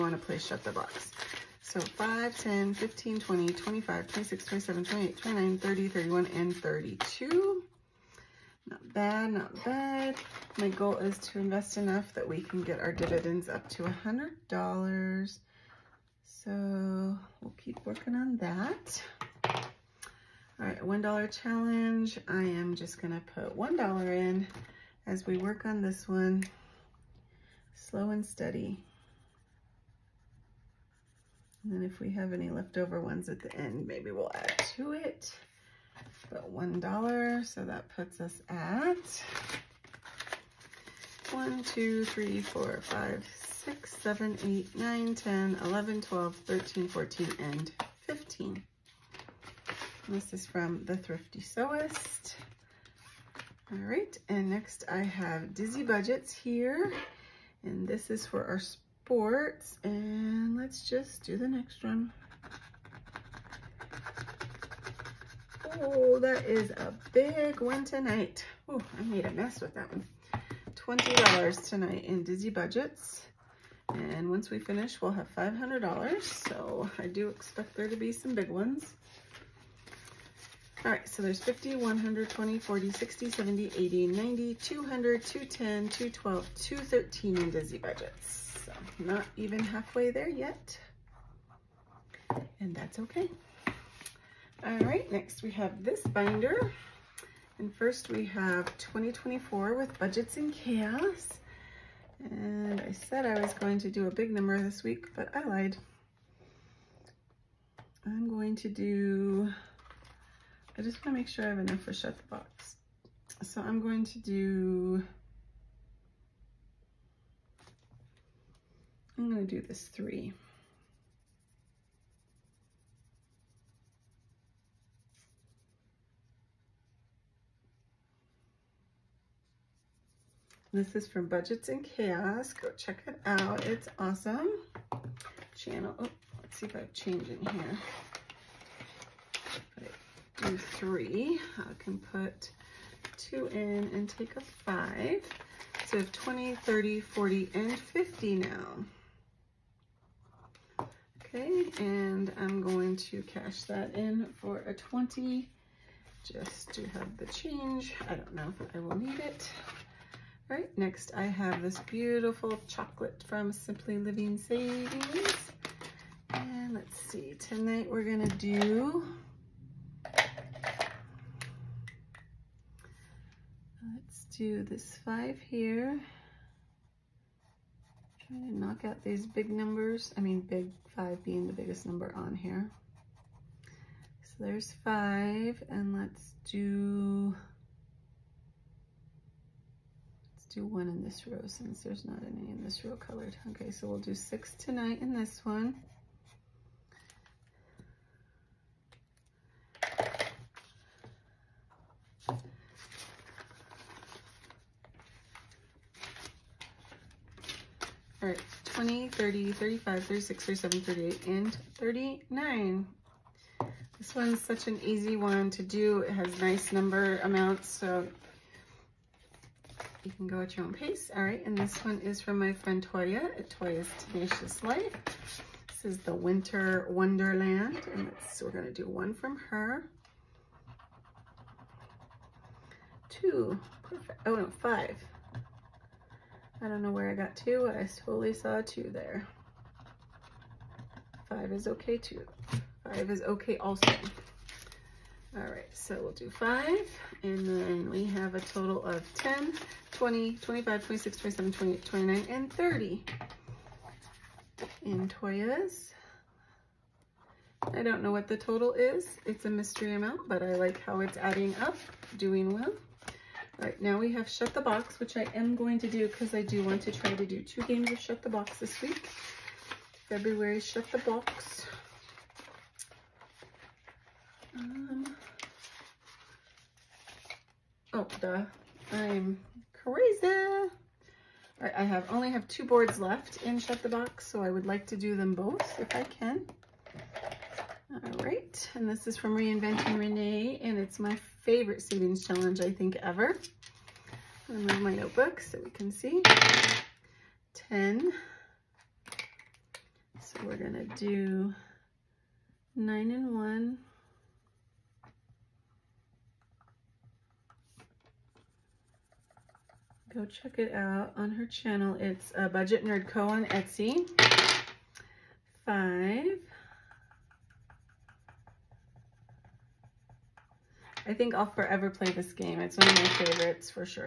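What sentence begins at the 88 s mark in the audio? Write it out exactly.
So not even halfway there yet, and that's okay.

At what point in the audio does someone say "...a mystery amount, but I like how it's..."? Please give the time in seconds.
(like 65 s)
259 s.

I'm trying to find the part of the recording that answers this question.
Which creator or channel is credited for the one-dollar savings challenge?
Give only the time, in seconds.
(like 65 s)
50 s.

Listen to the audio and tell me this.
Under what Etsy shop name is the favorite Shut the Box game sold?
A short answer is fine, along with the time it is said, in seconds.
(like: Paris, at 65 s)
Budget Nerd Co, at 312 s.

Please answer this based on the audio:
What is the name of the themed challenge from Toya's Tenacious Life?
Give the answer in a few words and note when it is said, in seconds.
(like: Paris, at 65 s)
Winter Wonderland, at 226 s.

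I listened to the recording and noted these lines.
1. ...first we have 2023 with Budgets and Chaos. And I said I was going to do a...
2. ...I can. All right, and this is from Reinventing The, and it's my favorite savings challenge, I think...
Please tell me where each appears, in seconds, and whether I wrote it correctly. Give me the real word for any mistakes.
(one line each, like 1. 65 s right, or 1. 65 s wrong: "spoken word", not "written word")
1. 97 s wrong: "2024", not "2023"
2. 285 s wrong: "Renee", not "The".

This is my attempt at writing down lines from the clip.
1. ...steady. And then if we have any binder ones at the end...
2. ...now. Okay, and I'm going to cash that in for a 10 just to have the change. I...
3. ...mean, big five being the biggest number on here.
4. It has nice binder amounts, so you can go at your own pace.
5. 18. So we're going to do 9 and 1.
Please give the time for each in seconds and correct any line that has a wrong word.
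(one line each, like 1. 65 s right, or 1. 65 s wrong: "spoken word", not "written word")
1. 28 s wrong: "leftover", not "binder"
2. 148 s wrong: "20", not "10"
3. 180 s right
4. 216 s wrong: "number", not "binder"
5. 297 s wrong: "10", not "18".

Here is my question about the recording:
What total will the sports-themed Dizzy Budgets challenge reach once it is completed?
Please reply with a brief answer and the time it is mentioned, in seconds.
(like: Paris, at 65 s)
$500, at 75 s.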